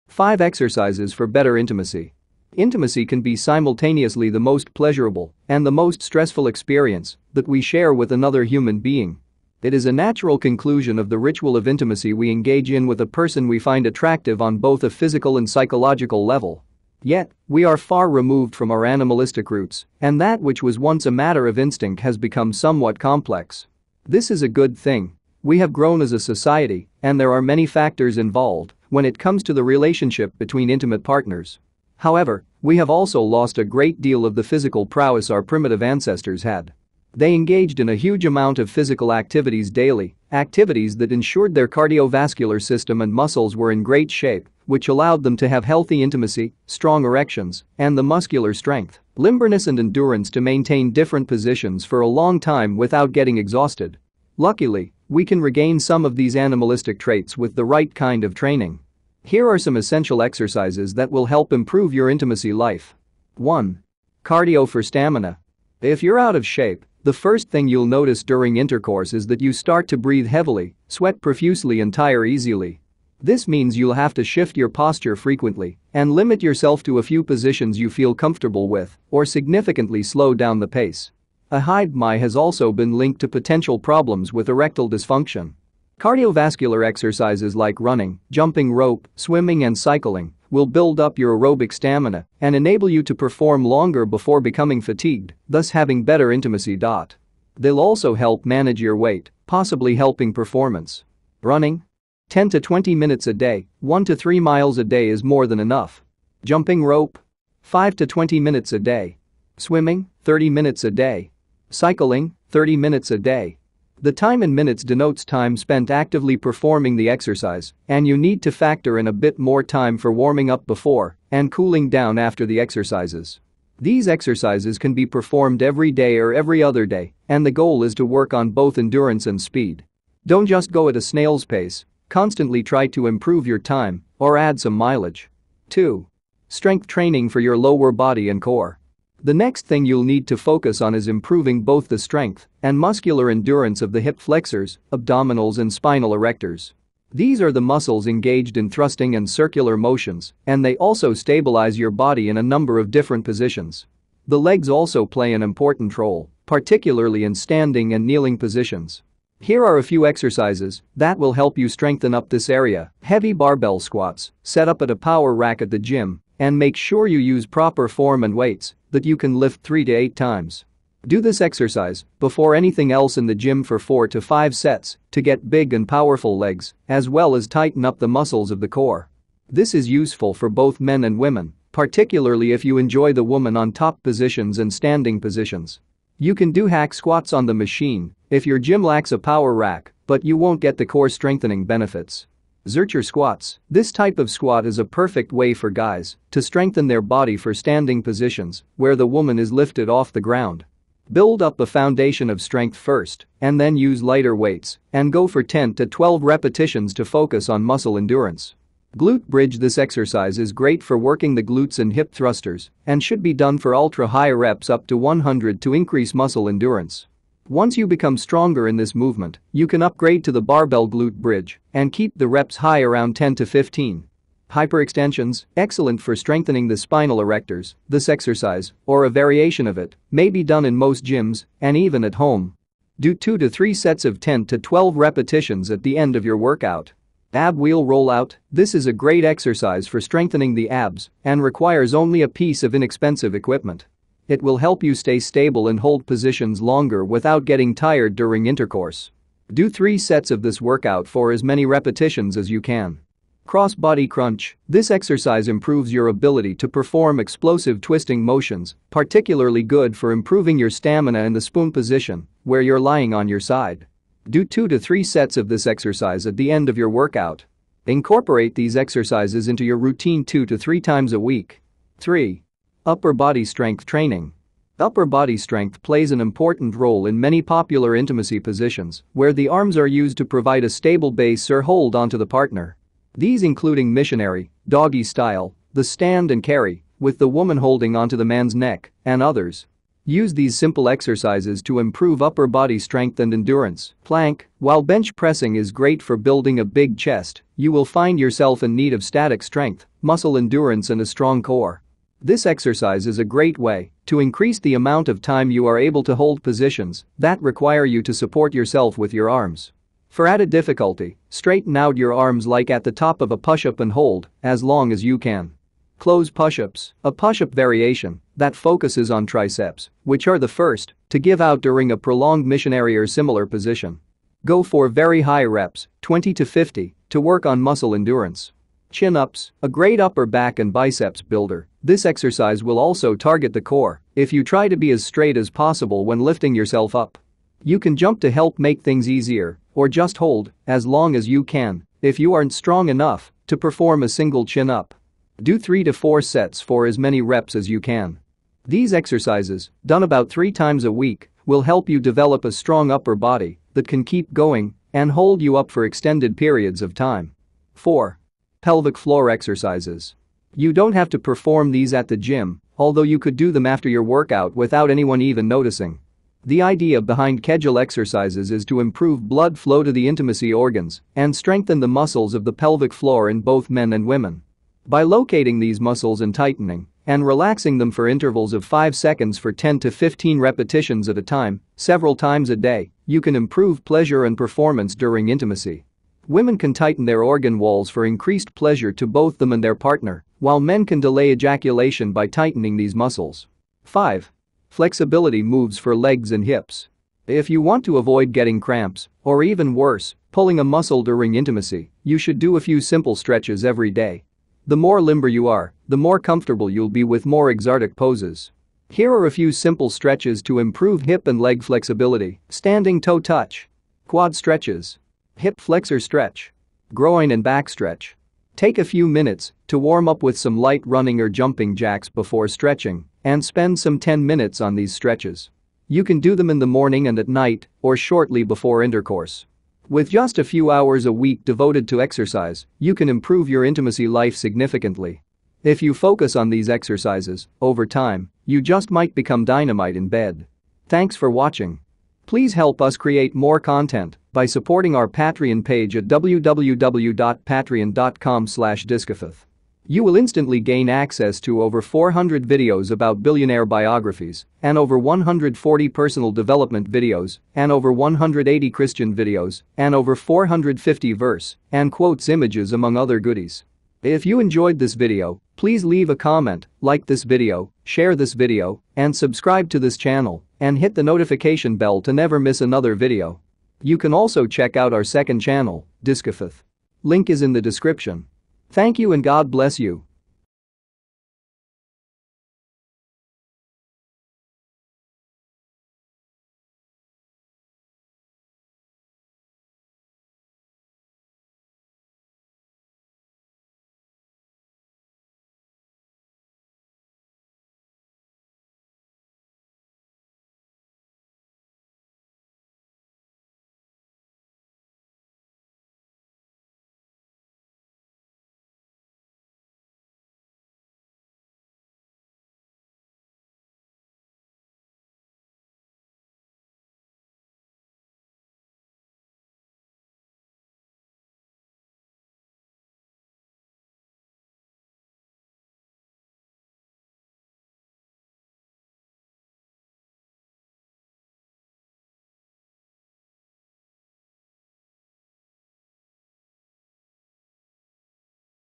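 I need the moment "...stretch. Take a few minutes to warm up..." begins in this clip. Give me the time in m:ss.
6:57.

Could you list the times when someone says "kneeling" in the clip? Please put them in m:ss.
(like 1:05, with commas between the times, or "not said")
2:38.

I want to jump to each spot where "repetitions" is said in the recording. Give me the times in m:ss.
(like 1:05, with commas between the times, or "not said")
3:26, 3:54, 4:11, 6:20.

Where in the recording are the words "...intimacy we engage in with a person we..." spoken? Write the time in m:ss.
0:11.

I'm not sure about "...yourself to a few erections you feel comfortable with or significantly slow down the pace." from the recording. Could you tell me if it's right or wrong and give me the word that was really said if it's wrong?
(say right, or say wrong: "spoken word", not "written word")
wrong: "positions", not "erections".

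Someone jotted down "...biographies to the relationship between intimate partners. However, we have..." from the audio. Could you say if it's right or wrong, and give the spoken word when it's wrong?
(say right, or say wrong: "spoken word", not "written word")
wrong: "comes", not "biographies".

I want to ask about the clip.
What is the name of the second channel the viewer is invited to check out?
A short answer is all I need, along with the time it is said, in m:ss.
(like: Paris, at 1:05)
Diskifaith, at 7:56.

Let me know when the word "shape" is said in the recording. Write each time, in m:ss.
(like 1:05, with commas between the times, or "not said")
0:44, 1:06.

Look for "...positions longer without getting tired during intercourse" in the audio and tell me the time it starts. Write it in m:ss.
4:06.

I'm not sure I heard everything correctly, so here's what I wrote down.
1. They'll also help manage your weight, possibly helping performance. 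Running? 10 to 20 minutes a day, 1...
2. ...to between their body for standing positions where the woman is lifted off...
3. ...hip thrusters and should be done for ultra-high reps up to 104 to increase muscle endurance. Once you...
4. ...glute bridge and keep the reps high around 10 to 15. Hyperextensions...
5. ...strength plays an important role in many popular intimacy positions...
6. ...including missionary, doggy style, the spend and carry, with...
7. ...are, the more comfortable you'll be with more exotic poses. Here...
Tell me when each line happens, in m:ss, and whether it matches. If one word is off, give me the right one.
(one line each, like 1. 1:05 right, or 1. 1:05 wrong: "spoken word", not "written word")
1. 1:36 right
2. 3:16 wrong: "strengthen", not "between"
3. 3:31 wrong: "100", not "104"
4. 3:40 right
5. 4:35 right
6. 4:43 wrong: "stand", not "spend"
7. 6:45 right.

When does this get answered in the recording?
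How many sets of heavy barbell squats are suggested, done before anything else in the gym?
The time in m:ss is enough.
2:53.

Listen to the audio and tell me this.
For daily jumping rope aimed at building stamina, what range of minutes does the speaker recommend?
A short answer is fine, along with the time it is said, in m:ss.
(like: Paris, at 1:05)
5 to 20 minutes, at 1:47.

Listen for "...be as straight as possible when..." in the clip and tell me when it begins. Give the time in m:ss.
5:34.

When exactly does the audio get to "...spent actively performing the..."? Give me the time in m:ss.
1:55.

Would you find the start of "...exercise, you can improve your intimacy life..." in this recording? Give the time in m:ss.
7:12.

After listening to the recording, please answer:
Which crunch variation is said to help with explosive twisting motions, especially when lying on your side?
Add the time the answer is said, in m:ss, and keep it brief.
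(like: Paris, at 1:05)
Cross-body crunch, at 4:13.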